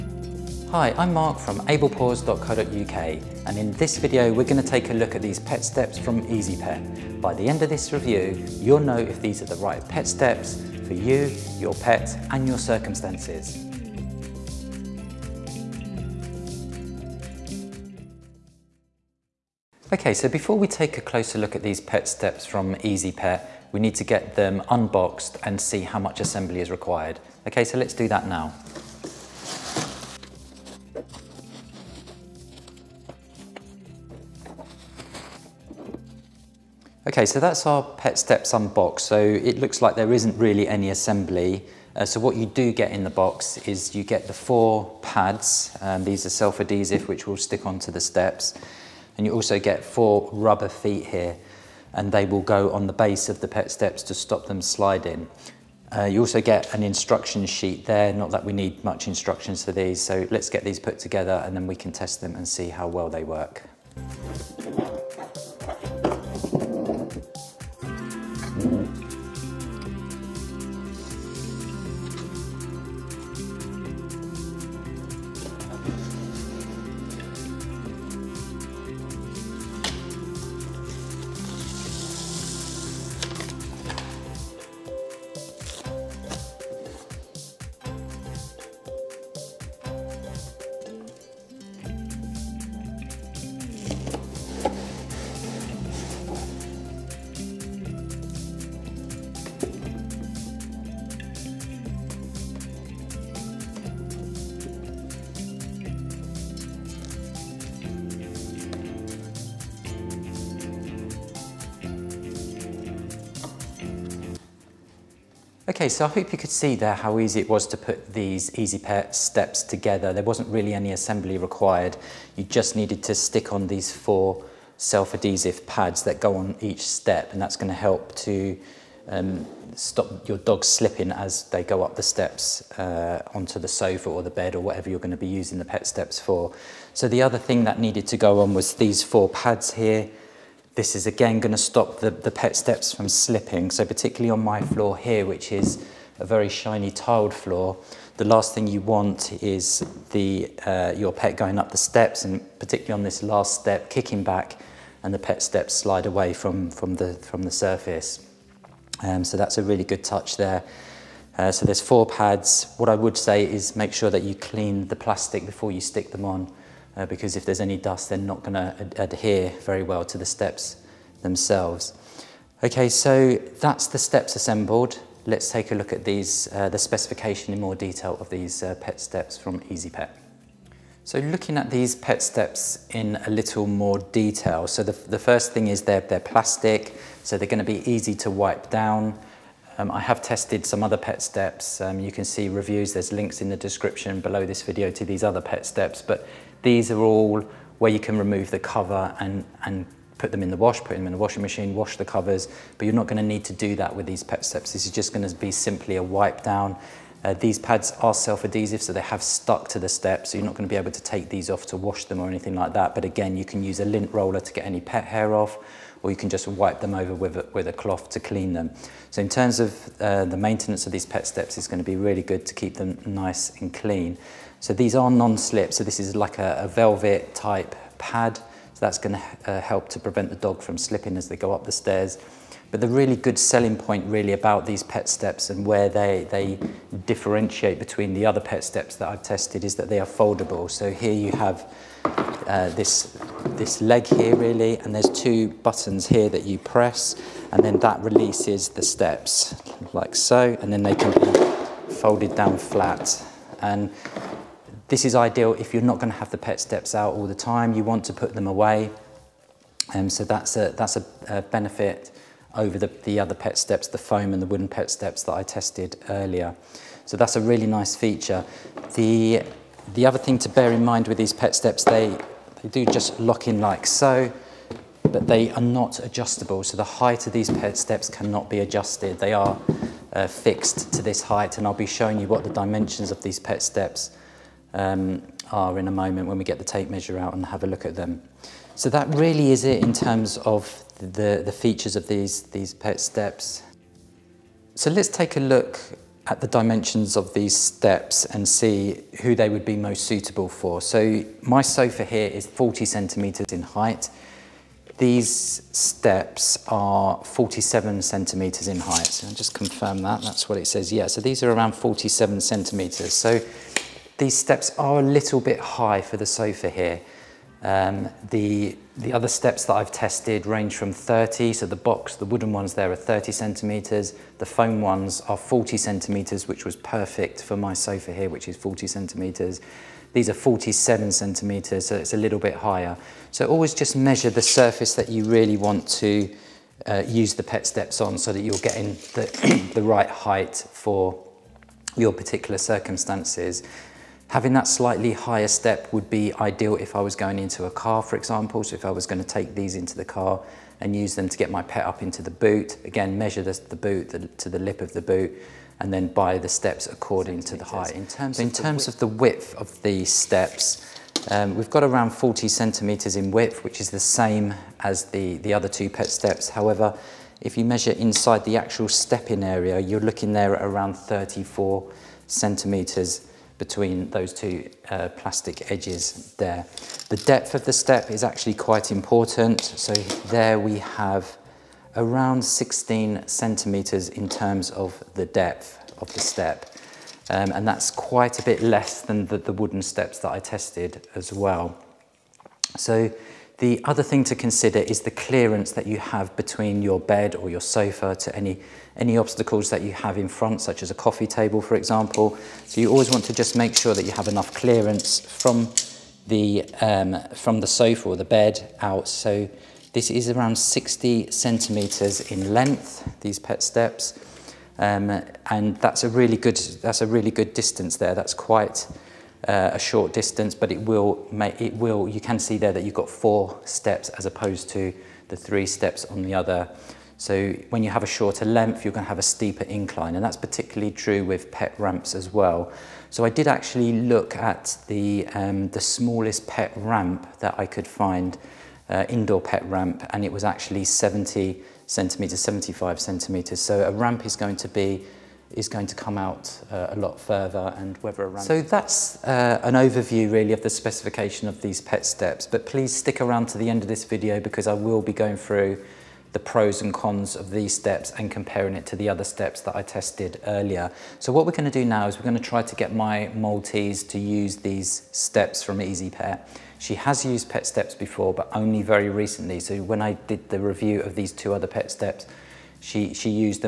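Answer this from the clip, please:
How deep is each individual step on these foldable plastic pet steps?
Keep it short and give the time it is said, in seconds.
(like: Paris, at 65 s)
16 centimeters, at 382 s.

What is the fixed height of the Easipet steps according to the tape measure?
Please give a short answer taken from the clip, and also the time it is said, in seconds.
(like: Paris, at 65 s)
47 centimeters, at 307 s.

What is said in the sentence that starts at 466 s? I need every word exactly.
She has used pet steps before, but only very recently.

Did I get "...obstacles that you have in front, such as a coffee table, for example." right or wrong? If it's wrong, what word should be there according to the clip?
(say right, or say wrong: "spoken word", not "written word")
right.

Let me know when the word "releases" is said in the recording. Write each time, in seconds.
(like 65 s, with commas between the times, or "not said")
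248 s.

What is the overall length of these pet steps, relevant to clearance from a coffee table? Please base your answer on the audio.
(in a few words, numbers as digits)
60 centimeters.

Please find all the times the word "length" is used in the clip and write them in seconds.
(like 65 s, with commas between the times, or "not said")
412 s, 428 s.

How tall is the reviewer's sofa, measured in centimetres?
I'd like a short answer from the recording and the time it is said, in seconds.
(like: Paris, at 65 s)
40 centimeters, at 302 s.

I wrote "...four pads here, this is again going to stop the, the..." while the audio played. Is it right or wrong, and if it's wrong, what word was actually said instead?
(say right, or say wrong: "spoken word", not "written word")
right.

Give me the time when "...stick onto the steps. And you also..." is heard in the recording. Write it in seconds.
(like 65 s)
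47 s.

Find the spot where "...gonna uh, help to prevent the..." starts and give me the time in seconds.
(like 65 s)
228 s.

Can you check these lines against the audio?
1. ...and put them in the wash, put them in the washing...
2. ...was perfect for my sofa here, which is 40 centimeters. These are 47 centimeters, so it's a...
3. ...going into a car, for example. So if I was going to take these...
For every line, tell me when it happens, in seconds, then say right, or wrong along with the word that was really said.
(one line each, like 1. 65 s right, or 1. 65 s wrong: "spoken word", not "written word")
1. 199 s right
2. 326 s right
3. 347 s right.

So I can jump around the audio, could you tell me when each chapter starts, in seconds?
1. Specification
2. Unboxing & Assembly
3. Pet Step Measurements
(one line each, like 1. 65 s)
1. 183 s
2. 20 s
3. 295 s.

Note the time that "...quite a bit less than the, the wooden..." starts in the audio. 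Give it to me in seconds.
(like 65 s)
387 s.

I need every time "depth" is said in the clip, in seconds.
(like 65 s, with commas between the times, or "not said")
377 s, 385 s.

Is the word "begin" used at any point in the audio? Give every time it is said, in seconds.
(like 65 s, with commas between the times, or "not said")
not said.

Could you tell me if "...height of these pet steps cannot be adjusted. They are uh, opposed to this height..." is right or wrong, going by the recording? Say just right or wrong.
wrong.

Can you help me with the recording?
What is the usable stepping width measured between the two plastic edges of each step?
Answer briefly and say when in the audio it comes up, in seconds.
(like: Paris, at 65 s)
34 centimetres, at 370 s.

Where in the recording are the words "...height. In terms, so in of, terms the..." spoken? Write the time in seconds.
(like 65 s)
357 s.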